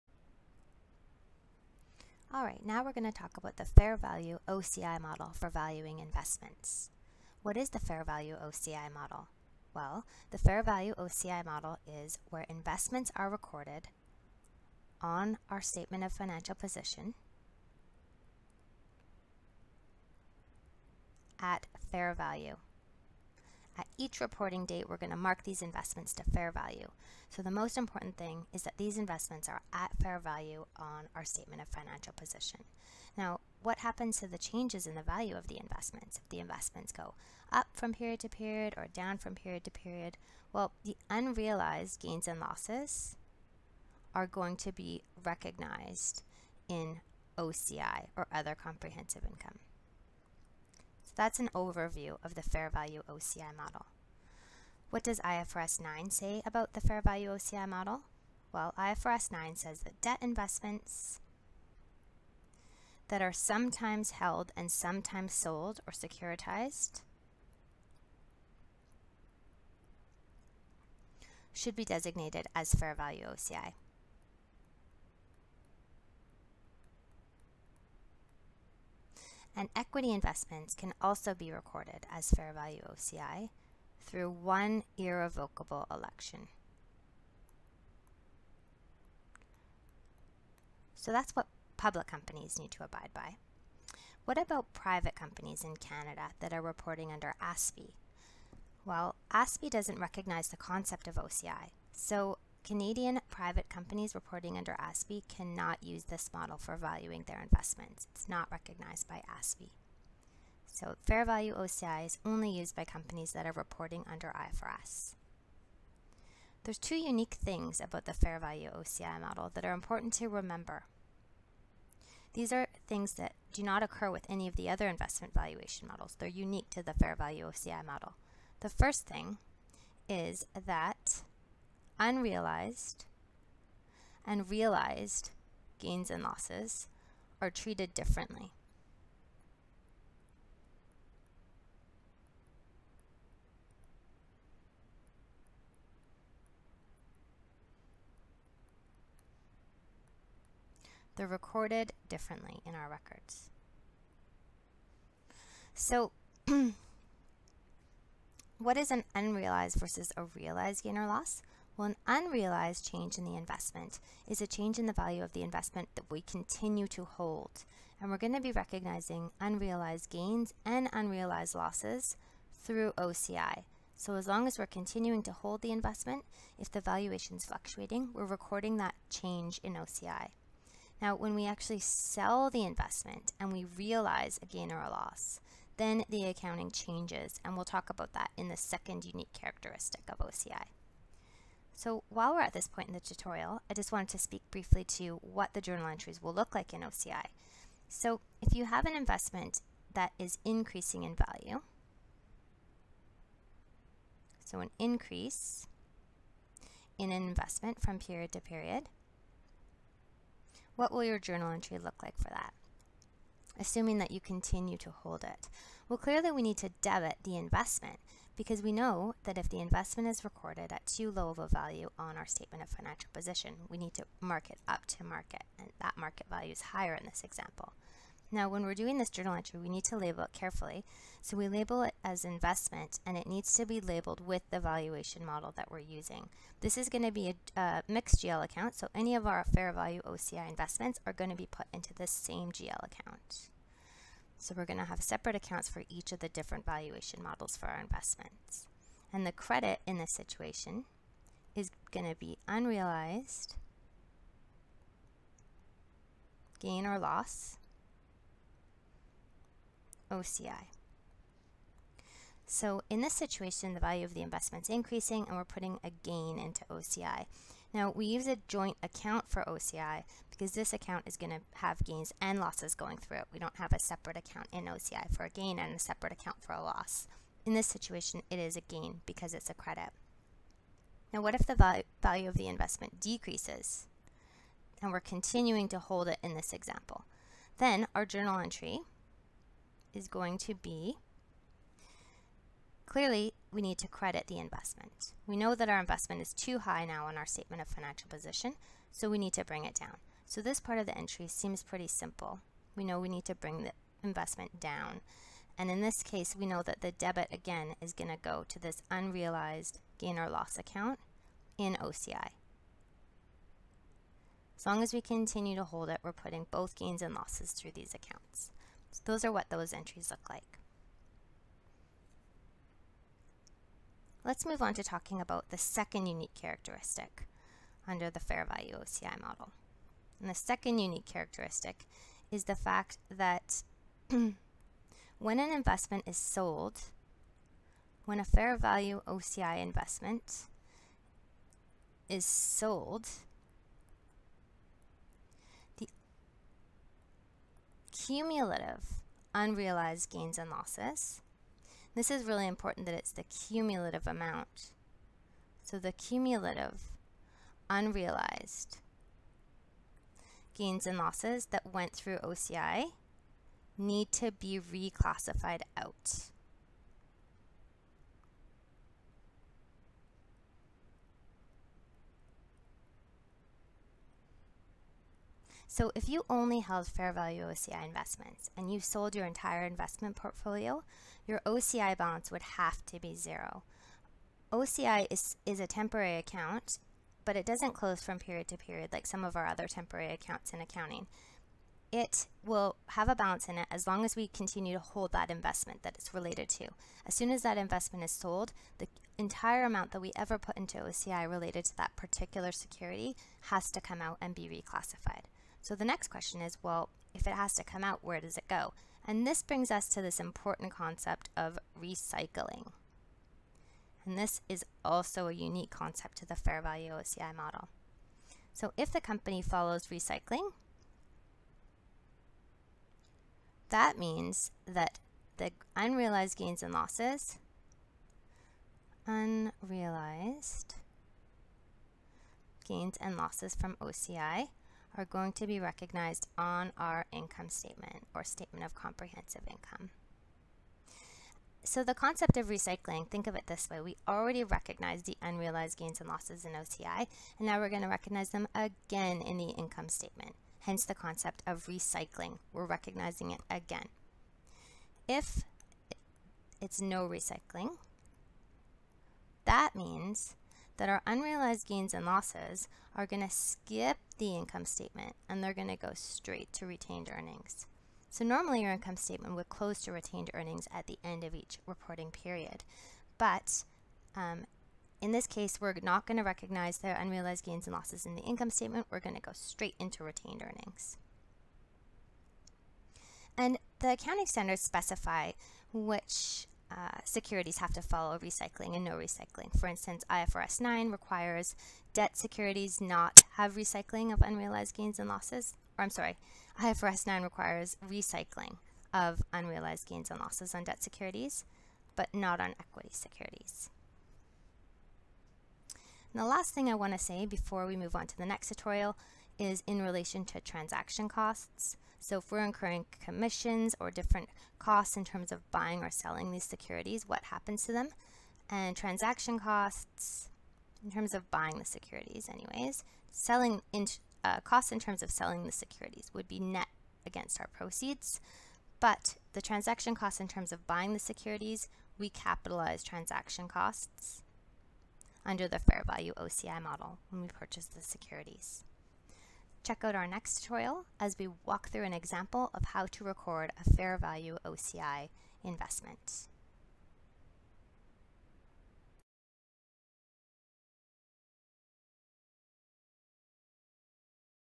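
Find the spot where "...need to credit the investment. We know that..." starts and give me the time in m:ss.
4:53.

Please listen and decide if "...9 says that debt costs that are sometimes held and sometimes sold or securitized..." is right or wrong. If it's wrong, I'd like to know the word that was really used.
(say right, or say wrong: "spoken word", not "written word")
wrong: "investments", not "costs".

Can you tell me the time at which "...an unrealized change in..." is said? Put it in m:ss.
2:41.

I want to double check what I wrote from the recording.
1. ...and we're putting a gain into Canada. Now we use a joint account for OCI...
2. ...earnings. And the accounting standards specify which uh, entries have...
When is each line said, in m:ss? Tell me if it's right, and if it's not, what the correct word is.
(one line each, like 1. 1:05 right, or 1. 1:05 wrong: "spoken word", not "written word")
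1. 4:25 wrong: "OCI", not "Canada"
2. 8:00 wrong: "securities", not "entries".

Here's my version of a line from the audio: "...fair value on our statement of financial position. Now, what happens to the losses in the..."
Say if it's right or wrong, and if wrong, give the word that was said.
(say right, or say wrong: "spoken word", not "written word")
wrong: "changes", not "losses".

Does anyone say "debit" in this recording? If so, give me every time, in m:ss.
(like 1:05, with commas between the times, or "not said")
3:36, 5:06.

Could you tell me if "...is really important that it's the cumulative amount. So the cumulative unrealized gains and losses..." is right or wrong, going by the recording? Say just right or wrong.
right.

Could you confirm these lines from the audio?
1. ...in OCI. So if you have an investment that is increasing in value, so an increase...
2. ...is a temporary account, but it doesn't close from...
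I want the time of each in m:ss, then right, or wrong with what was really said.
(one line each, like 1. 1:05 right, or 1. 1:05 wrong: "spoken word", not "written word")
1. 3:16 right
2. 6:25 right.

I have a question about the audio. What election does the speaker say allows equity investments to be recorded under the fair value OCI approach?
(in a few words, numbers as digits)
One irrevocable election.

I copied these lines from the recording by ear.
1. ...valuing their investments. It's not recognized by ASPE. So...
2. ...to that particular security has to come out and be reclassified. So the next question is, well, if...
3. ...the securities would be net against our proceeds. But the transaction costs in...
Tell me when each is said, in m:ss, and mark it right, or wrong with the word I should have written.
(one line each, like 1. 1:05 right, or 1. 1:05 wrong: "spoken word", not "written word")
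1. 1:46 right
2. 6:41 right
3. 8:45 right.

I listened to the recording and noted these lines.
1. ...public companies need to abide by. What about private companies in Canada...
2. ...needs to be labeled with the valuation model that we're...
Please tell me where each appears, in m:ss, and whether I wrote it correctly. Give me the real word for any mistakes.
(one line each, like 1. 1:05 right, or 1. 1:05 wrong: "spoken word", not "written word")
1. 1:31 right
2. 3:53 right.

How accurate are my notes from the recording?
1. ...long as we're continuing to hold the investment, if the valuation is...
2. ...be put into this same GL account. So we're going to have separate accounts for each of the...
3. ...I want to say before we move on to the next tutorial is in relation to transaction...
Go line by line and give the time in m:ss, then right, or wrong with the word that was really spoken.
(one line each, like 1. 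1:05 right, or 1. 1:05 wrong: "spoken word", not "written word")
1. 2:54 right
2. 4:01 right
3. 8:26 right.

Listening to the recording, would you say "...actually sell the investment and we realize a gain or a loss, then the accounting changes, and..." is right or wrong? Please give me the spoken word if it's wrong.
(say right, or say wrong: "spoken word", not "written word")
right.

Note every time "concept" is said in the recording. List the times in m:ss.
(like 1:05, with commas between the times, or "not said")
1:40, 6:50, 6:55, 7:21, 7:30.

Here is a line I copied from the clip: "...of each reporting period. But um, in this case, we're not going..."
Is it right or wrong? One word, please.
right.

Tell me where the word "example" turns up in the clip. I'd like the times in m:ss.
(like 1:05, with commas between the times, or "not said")
3:47, 4:46, 9:01.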